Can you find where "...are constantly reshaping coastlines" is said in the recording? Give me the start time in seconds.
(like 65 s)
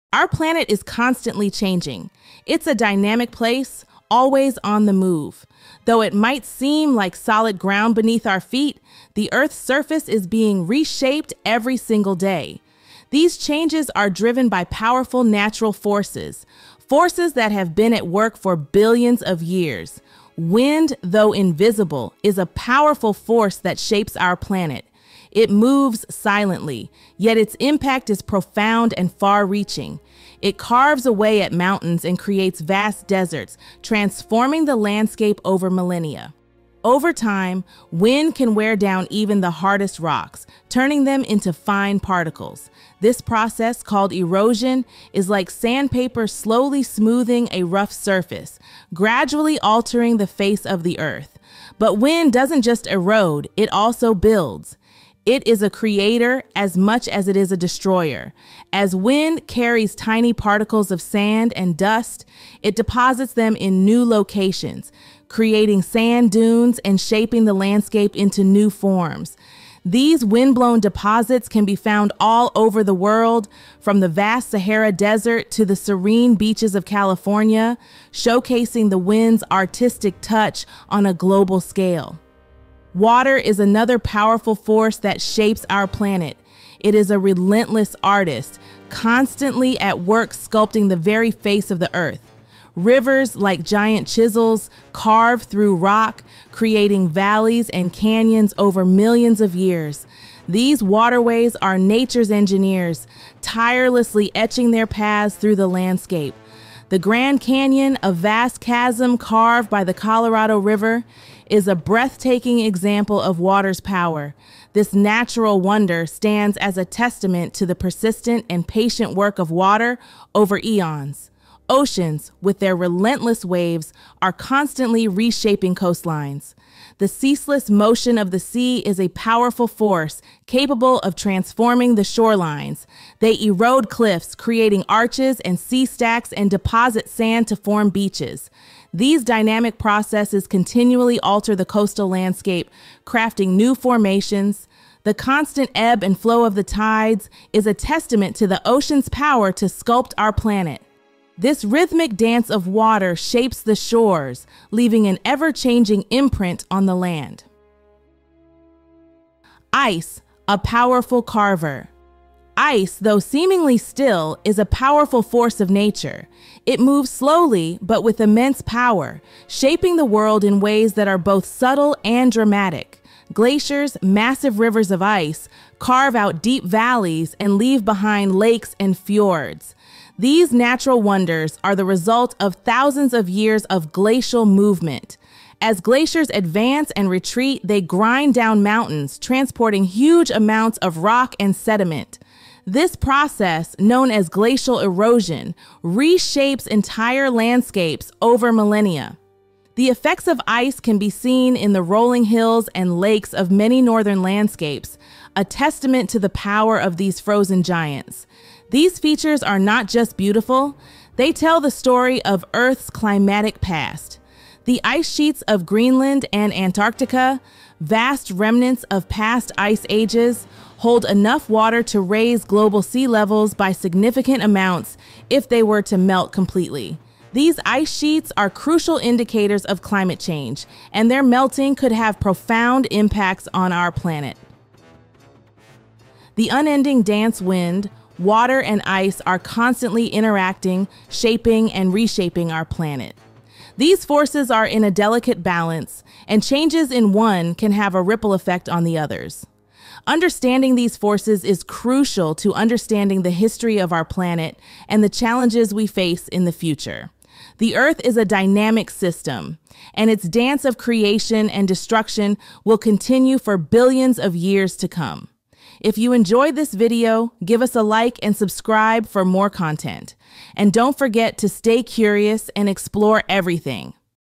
124 s.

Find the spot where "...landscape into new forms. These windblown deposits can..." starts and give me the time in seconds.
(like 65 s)
67 s.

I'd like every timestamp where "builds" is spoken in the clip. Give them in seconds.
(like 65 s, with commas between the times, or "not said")
54 s.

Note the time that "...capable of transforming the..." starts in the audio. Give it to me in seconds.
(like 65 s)
130 s.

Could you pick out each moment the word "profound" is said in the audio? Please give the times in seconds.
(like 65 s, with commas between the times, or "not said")
28 s, 232 s.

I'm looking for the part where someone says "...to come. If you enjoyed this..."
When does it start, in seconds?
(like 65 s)
264 s.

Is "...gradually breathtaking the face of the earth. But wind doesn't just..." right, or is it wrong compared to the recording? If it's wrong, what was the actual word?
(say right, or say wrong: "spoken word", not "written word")
wrong: "altering", not "breathtaking".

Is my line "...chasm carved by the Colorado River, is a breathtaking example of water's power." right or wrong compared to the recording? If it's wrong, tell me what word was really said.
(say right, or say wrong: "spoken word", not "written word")
right.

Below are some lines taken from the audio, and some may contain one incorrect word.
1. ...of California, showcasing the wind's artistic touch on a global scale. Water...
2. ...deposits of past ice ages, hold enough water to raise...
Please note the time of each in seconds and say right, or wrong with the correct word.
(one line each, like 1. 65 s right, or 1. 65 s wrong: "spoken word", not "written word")
1. 76 s right
2. 218 s wrong: "remnants", not "deposits".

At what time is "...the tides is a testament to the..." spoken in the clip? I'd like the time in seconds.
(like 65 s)
146 s.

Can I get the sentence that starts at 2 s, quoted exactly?
It's a dynamic place, always on the move.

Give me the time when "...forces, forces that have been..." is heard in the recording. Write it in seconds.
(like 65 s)
15 s.